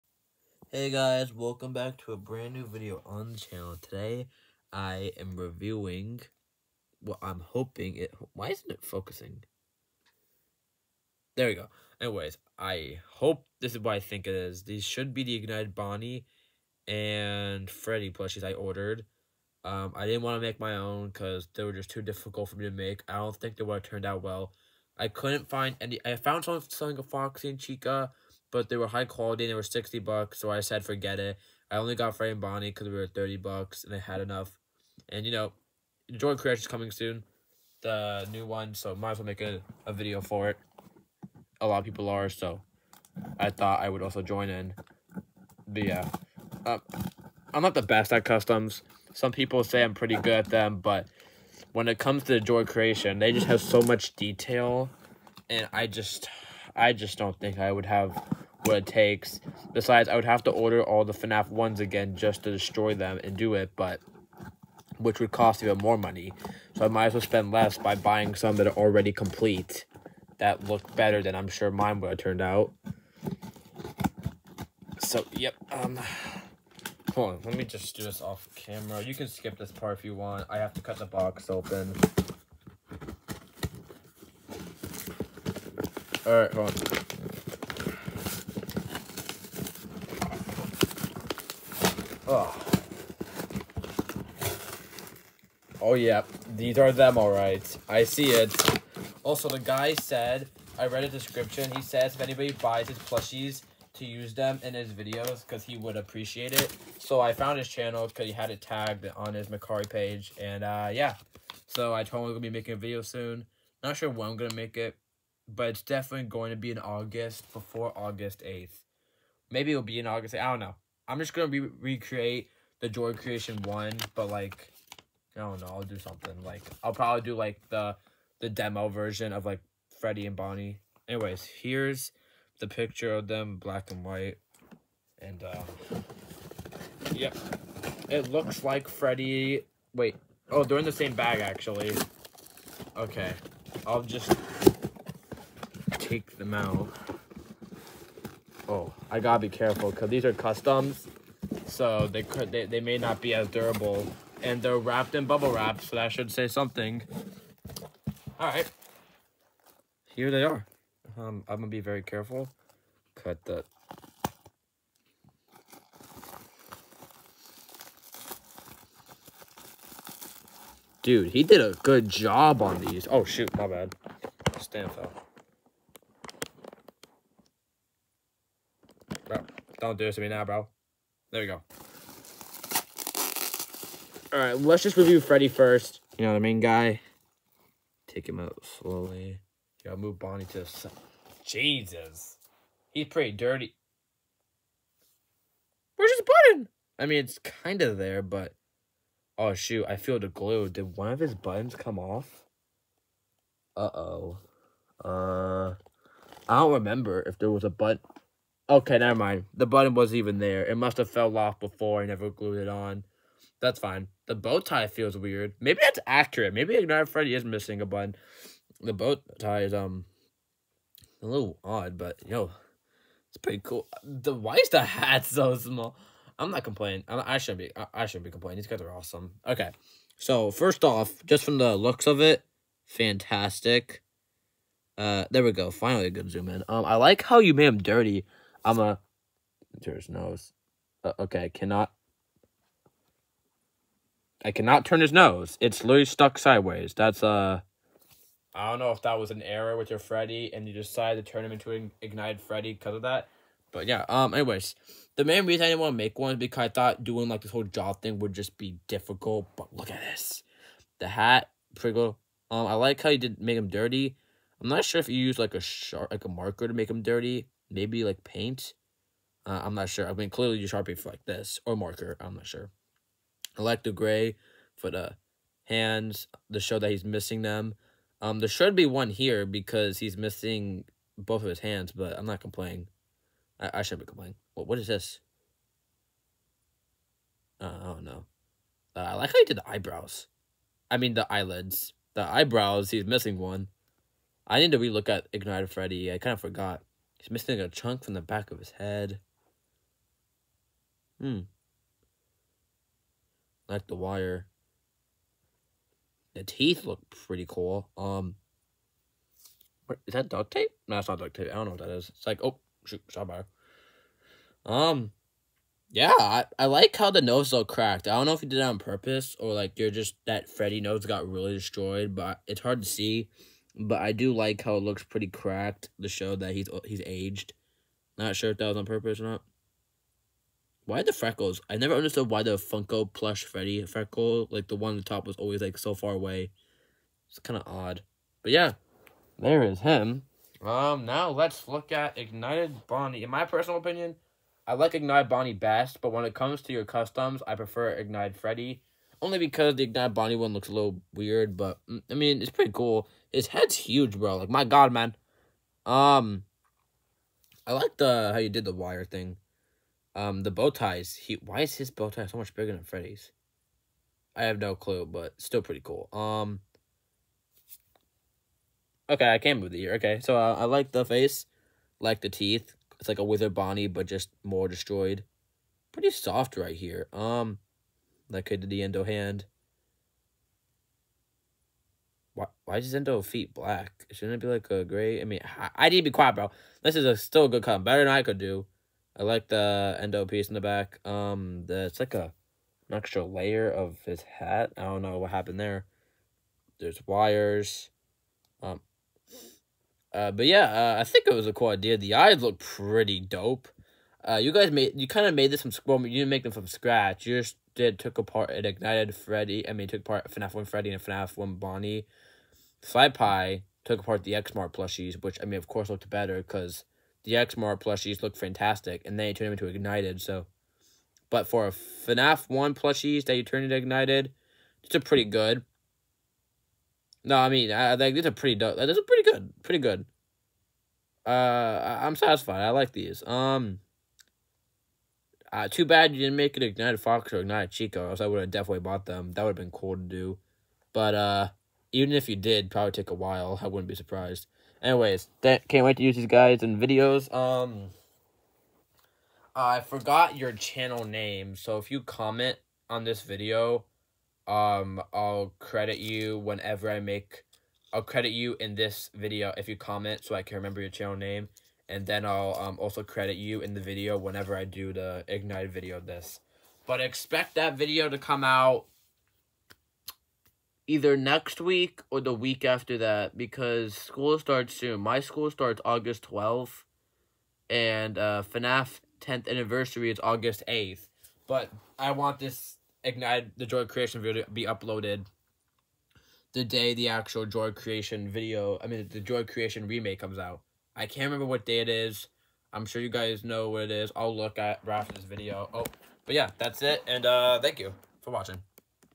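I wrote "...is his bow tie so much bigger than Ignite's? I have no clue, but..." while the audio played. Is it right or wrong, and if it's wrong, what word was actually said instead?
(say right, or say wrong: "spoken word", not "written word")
wrong: "Freddy", not "Ignite".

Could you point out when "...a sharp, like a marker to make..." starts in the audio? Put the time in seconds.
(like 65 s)
265 s.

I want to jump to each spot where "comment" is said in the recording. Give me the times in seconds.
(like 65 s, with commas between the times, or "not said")
451 s, 459 s.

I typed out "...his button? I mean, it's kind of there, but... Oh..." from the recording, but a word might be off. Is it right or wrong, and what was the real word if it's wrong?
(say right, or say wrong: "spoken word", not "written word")
right.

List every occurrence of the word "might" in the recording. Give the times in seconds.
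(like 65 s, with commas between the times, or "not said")
38 s, 66 s.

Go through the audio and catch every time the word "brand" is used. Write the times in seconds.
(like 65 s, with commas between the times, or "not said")
2 s.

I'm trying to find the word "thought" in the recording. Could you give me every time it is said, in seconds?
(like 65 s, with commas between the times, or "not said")
43 s, 256 s.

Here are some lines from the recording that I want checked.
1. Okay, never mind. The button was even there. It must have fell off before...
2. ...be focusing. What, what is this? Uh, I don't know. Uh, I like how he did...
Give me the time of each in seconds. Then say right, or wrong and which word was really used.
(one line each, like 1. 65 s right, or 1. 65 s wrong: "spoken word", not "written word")
1. 208 s right
2. 284 s wrong: "complaining", not "focusing".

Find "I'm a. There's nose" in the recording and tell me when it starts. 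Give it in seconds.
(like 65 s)
238 s.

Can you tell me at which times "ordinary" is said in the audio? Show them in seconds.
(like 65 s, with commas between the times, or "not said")
not said.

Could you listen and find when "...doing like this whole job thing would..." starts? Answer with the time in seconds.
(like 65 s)
257 s.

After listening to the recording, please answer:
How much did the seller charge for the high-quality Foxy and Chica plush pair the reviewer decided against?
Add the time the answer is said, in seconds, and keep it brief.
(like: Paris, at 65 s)
$60, at 29 s.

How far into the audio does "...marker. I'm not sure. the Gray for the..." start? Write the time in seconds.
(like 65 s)
271 s.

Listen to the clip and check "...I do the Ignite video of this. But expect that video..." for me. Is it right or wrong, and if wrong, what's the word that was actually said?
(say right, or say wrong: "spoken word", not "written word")
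right.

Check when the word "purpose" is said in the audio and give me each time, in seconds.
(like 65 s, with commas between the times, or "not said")
318 s, 328 s.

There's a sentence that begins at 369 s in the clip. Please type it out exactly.
Okay, so uh, I like the face, like the teeth.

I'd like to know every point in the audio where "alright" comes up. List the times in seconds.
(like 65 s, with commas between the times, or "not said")
86 s, 97 s.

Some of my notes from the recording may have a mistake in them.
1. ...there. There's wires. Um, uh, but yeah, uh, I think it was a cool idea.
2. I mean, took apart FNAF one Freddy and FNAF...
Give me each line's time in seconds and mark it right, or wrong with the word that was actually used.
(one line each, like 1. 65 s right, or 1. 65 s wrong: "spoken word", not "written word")
1. 395 s right
2. 409 s right.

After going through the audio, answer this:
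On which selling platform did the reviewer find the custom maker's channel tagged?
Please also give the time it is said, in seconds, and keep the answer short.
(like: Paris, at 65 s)
Mercari, at 109 s.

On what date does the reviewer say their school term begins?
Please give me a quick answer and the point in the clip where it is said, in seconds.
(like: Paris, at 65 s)
August 12th, at 475 s.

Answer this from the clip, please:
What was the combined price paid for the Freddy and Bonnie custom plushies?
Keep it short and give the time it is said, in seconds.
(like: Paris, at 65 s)
$30, at 33 s.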